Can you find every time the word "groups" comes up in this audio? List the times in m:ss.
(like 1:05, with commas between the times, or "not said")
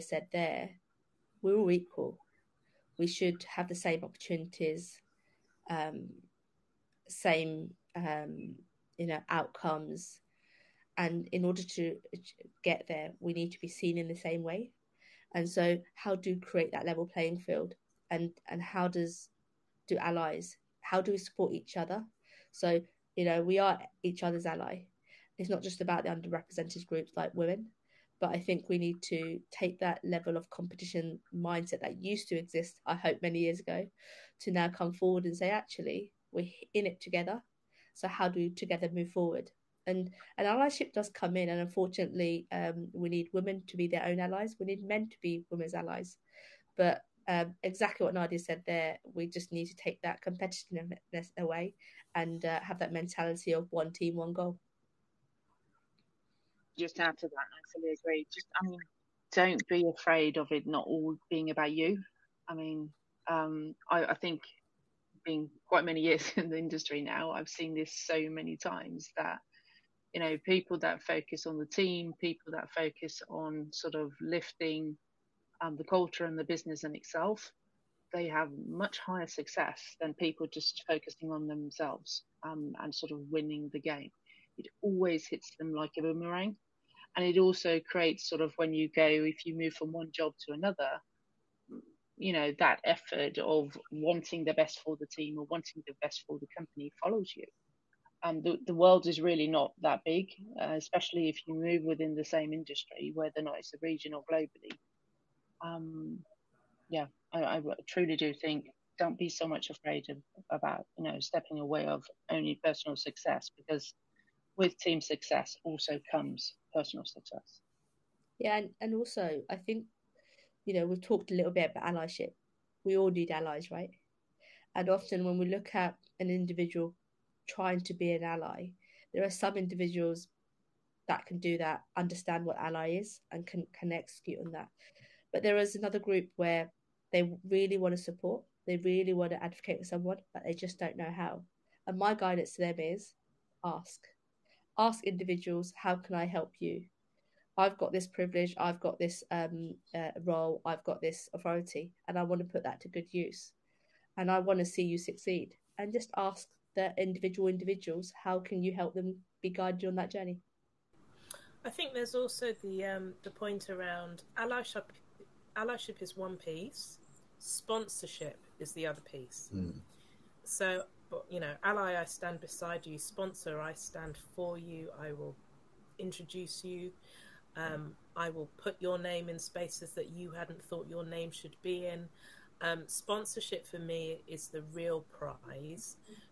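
0:26, 2:15.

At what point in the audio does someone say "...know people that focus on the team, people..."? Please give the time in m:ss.
1:10.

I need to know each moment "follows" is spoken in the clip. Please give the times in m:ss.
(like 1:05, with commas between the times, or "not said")
1:37.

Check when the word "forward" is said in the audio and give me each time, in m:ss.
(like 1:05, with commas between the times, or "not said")
0:34, 0:39.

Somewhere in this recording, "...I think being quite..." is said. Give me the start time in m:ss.
1:04.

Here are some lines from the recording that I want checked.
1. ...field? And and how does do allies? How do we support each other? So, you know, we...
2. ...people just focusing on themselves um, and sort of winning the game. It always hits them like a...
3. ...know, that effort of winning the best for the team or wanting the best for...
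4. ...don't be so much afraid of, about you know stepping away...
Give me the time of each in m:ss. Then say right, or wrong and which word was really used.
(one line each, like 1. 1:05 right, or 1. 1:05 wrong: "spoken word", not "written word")
1. 0:17 right
2. 1:20 right
3. 1:32 wrong: "wanting", not "winning"
4. 1:48 right.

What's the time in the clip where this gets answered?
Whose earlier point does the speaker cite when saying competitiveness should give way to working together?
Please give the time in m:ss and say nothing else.
0:48.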